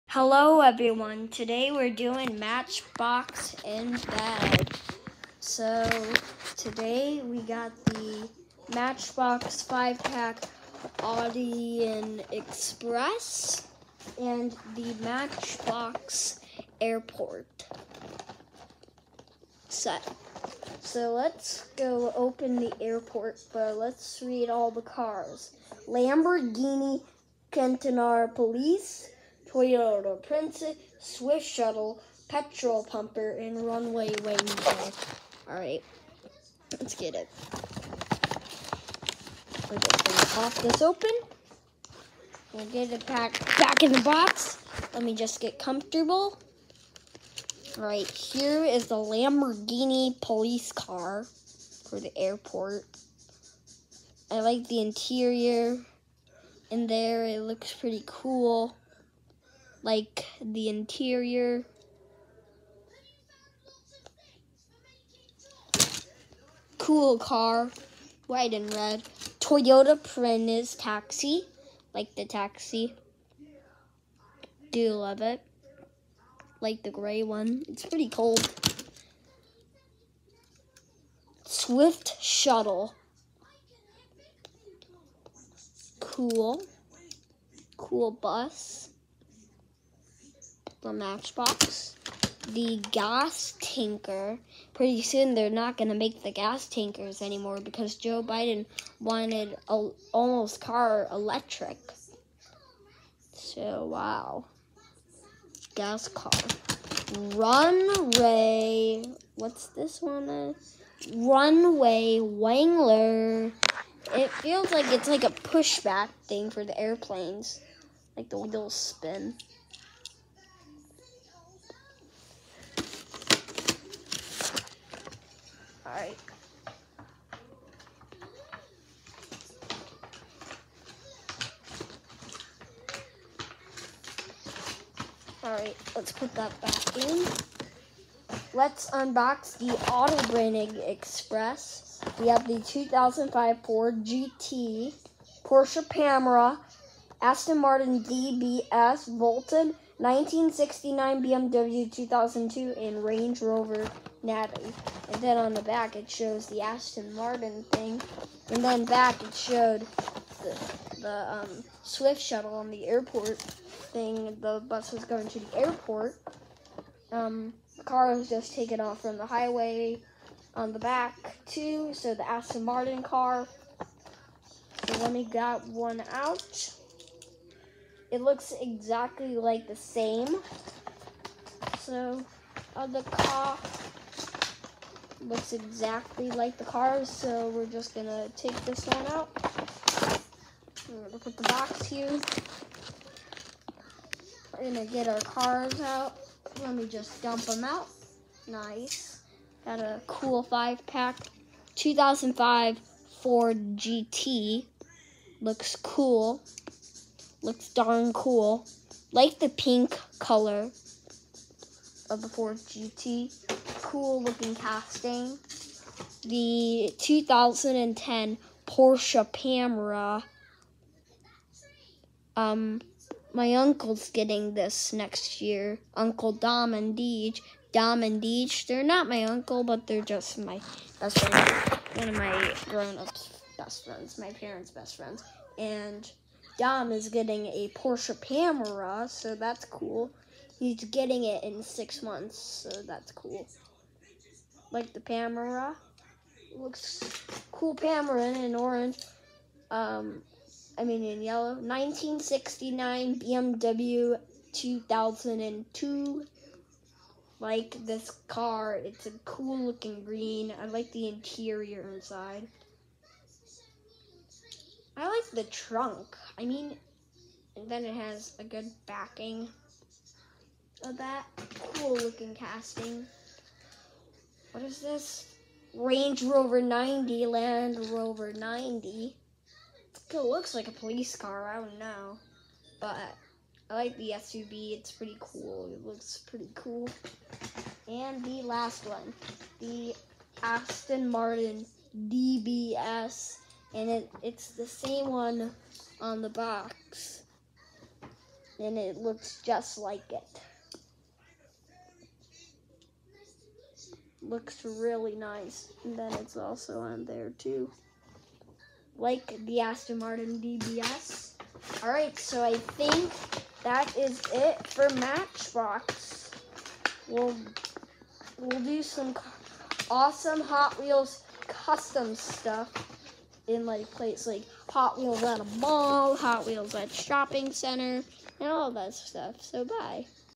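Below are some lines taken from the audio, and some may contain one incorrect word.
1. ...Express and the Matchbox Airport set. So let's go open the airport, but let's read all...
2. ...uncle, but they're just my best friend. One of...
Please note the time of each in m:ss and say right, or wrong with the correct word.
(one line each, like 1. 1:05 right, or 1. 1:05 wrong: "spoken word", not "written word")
1. 0:12 right
2. 3:49 right.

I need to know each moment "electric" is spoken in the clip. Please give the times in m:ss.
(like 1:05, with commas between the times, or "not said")
1:41.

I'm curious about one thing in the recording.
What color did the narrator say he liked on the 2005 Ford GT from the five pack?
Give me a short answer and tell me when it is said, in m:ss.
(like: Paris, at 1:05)
Pink, at 3:29.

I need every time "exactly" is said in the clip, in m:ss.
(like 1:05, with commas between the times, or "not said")
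2:58, 3:05.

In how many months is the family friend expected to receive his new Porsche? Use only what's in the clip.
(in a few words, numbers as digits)
6.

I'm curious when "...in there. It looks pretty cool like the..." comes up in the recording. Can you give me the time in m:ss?
0:56.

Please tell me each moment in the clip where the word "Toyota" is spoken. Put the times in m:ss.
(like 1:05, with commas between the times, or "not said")
0:29, 1:09.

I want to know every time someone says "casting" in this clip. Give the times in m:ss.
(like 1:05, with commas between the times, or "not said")
3:34, 4:32.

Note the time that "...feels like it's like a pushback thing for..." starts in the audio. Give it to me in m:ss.
1:54.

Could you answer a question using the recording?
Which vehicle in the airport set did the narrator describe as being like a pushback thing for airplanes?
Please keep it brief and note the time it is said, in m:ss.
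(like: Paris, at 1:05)
Runway Ranger, at 0:33.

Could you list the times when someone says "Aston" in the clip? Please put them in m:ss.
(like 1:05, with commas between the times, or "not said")
2:27, 2:36, 2:52, 4:50, 5:09.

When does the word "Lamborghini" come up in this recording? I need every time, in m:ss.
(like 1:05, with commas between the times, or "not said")
0:25, 0:48.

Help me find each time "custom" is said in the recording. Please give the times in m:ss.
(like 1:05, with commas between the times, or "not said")
5:21.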